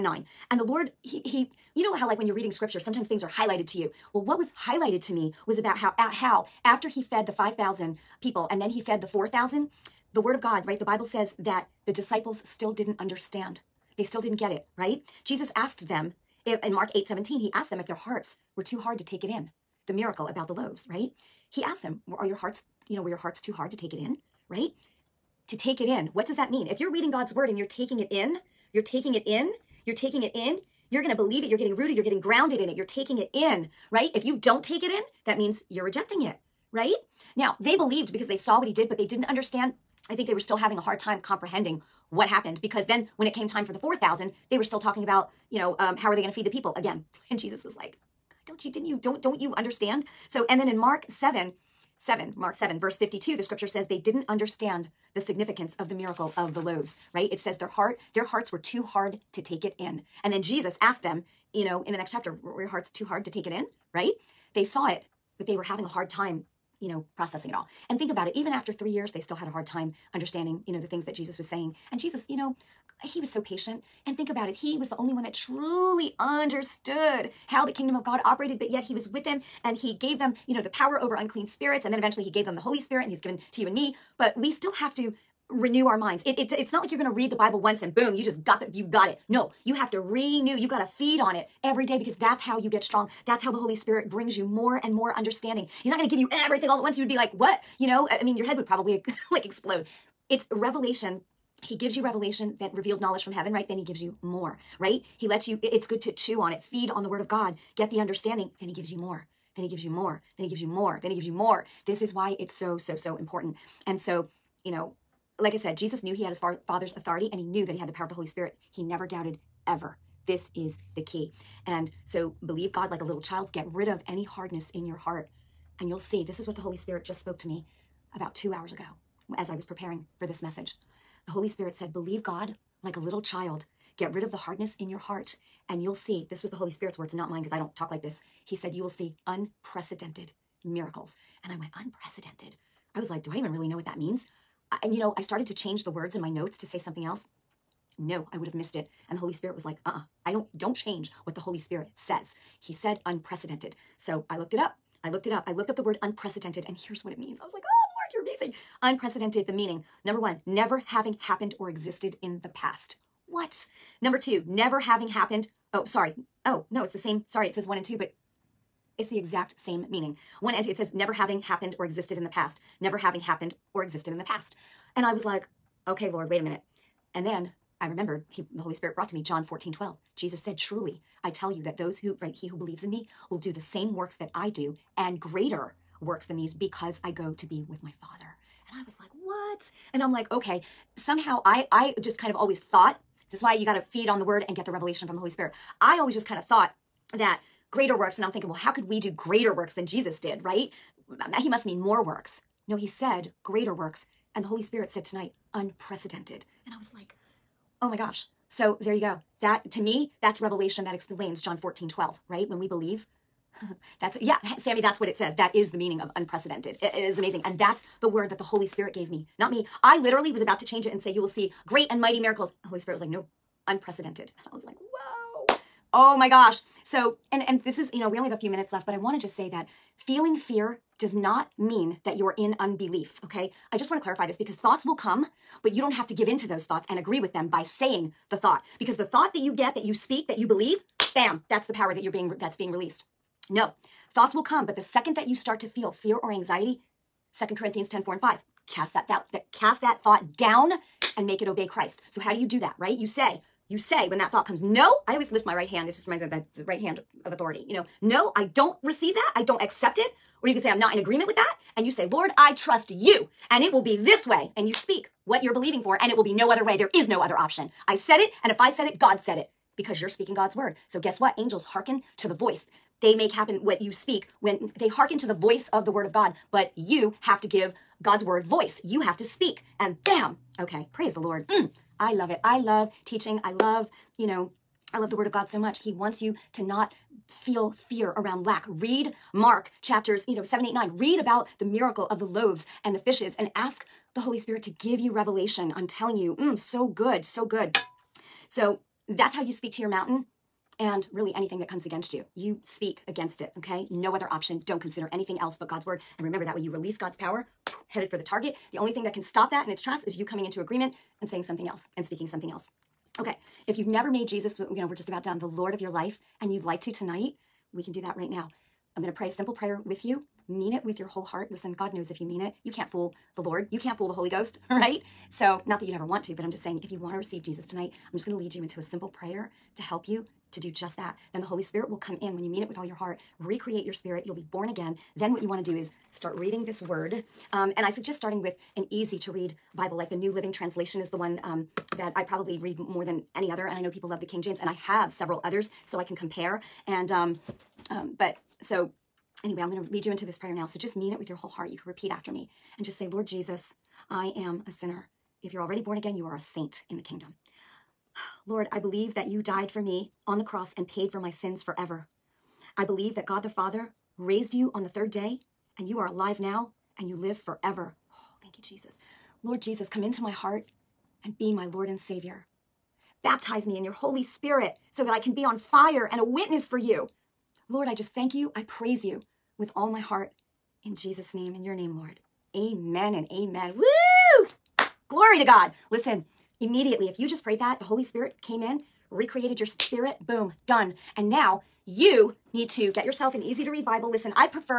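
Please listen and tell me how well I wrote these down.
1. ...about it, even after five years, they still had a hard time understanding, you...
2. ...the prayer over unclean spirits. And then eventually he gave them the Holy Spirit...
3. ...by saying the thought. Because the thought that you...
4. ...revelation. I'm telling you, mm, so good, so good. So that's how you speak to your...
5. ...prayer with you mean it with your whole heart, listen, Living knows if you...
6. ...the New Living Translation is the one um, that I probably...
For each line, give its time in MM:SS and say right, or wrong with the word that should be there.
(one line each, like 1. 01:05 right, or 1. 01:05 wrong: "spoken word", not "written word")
1. 01:08 wrong: "three", not "five"
2. 01:20 wrong: "power", not "prayer"
3. 03:57 right
4. 04:55 right
5. 05:19 wrong: "God", not "Living"
6. 05:40 right.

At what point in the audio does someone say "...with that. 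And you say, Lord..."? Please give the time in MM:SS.
04:21.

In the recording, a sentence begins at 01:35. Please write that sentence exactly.
He's not going to give you everything all at once.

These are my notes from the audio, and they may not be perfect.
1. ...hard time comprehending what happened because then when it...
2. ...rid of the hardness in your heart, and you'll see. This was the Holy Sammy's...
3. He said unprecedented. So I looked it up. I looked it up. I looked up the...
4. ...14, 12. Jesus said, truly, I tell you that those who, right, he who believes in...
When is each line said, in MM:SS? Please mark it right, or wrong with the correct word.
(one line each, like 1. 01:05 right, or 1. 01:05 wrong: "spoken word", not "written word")
1. 00:40 right
2. 02:14 wrong: "Spirit", not "Sammy"
3. 02:32 right
4. 02:59 right.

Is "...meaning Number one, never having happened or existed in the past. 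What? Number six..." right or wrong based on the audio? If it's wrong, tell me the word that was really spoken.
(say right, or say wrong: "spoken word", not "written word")
wrong: "two", not "six".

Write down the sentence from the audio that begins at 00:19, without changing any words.
The miracle about the loaves, right?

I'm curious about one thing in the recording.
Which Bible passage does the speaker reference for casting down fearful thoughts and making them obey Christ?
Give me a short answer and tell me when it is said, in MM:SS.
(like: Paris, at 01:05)
2 Corinthians 10:4-5, at 04:07.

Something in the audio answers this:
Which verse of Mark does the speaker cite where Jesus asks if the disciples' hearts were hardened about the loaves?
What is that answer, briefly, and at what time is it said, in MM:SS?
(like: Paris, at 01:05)
Mark 8:17, at 00:16.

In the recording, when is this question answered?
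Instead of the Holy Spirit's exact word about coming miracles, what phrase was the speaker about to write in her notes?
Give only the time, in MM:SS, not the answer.
03:41.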